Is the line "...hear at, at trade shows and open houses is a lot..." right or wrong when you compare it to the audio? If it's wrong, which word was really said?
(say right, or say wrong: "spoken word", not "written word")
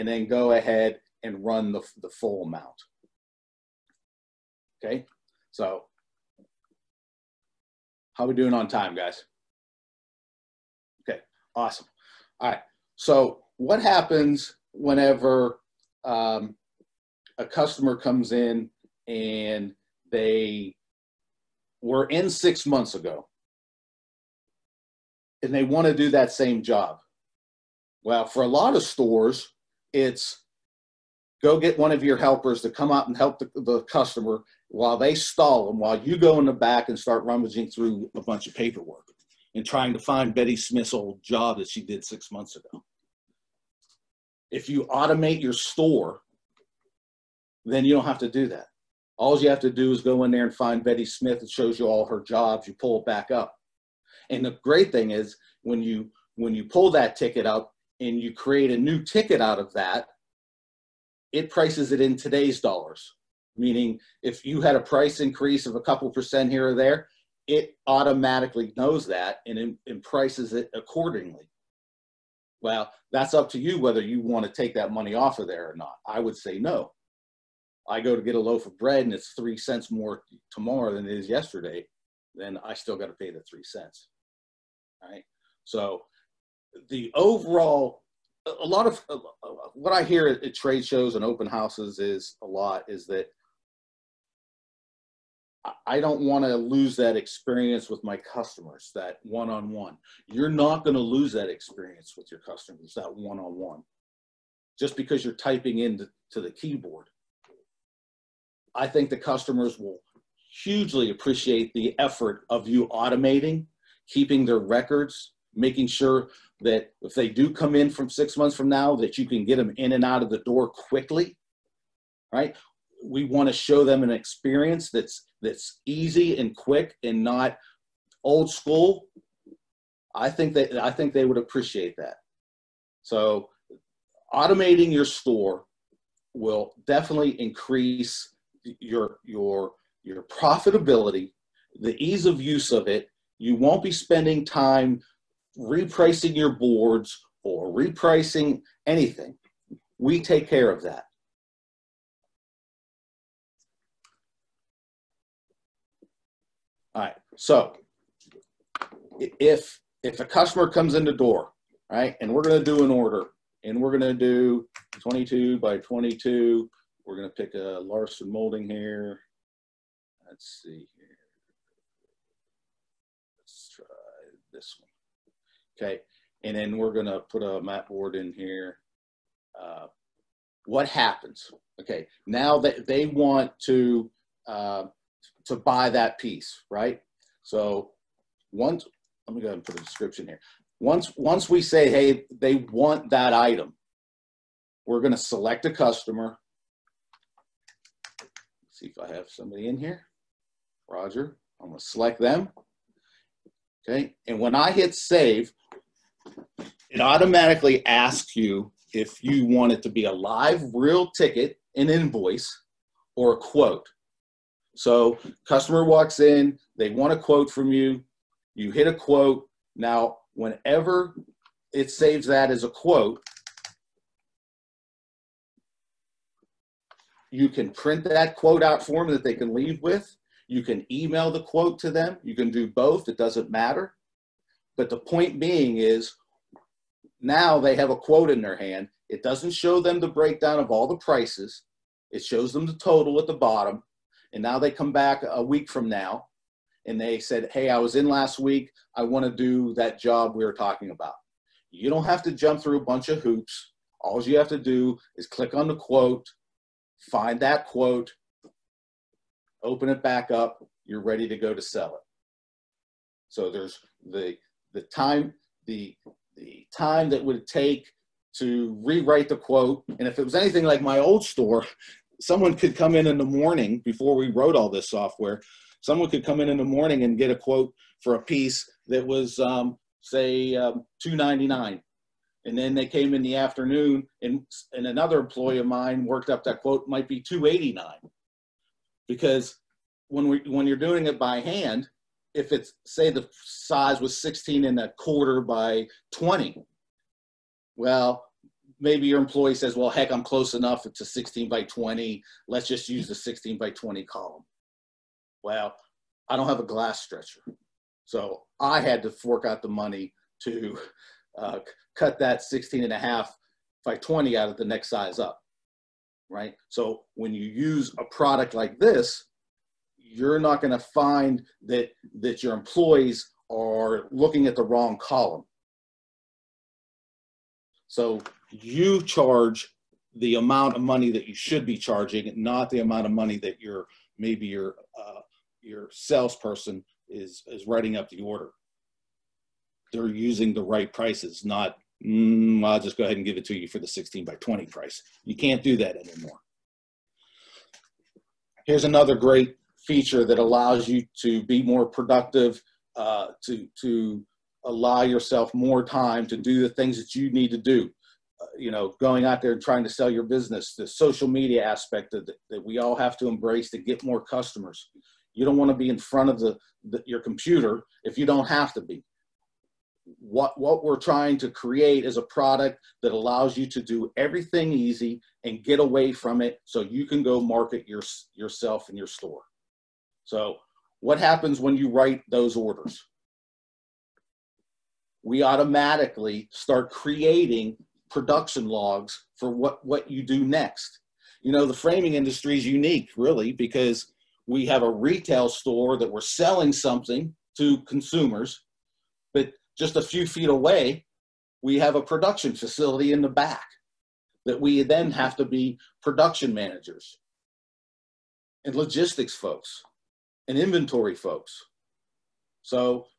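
right.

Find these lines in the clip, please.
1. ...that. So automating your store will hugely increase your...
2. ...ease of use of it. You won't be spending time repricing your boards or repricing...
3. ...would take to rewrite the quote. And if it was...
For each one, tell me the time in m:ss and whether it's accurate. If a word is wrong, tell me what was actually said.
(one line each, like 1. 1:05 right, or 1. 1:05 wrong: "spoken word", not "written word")
1. 2:11 wrong: "definitely", not "hugely"
2. 2:22 right
3. 4:27 right.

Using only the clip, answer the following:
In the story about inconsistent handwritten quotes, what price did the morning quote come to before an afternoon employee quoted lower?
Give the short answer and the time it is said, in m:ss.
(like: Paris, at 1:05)
299, at 4:41.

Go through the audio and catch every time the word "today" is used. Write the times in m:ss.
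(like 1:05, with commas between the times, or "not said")
1:02.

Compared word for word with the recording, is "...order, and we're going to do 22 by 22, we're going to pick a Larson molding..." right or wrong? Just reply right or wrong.
right.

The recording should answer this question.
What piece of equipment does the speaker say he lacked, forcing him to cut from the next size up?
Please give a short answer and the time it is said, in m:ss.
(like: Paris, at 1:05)
glass stretcher, at 5:06.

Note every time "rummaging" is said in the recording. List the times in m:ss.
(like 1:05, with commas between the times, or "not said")
0:37.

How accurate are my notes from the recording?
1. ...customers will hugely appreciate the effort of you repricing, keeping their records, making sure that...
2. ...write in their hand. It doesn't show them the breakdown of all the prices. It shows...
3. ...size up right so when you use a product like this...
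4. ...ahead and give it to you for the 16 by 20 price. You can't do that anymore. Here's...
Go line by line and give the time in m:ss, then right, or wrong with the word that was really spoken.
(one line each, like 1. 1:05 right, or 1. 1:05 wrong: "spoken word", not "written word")
1. 1:49 wrong: "automating", not "repricing"
2. 3:57 wrong: "quote", not "write"
3. 5:14 right
4. 5:43 right.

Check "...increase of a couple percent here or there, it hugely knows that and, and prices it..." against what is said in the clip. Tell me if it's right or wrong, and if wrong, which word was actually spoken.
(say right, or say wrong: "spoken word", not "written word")
wrong: "automatically", not "hugely".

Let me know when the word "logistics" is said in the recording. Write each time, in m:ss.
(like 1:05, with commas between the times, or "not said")
6:48.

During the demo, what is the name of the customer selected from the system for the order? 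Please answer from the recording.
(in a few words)
Roger.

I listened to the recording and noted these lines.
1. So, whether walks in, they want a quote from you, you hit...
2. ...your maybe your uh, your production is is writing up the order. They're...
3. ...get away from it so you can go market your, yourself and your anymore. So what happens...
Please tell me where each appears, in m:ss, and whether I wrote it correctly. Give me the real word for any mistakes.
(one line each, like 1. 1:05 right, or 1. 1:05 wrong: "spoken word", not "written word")
1. 3:34 wrong: "customer", not "whether"
2. 5:33 wrong: "salesperson", not "production"
3. 6:15 wrong: "store", not "anymore".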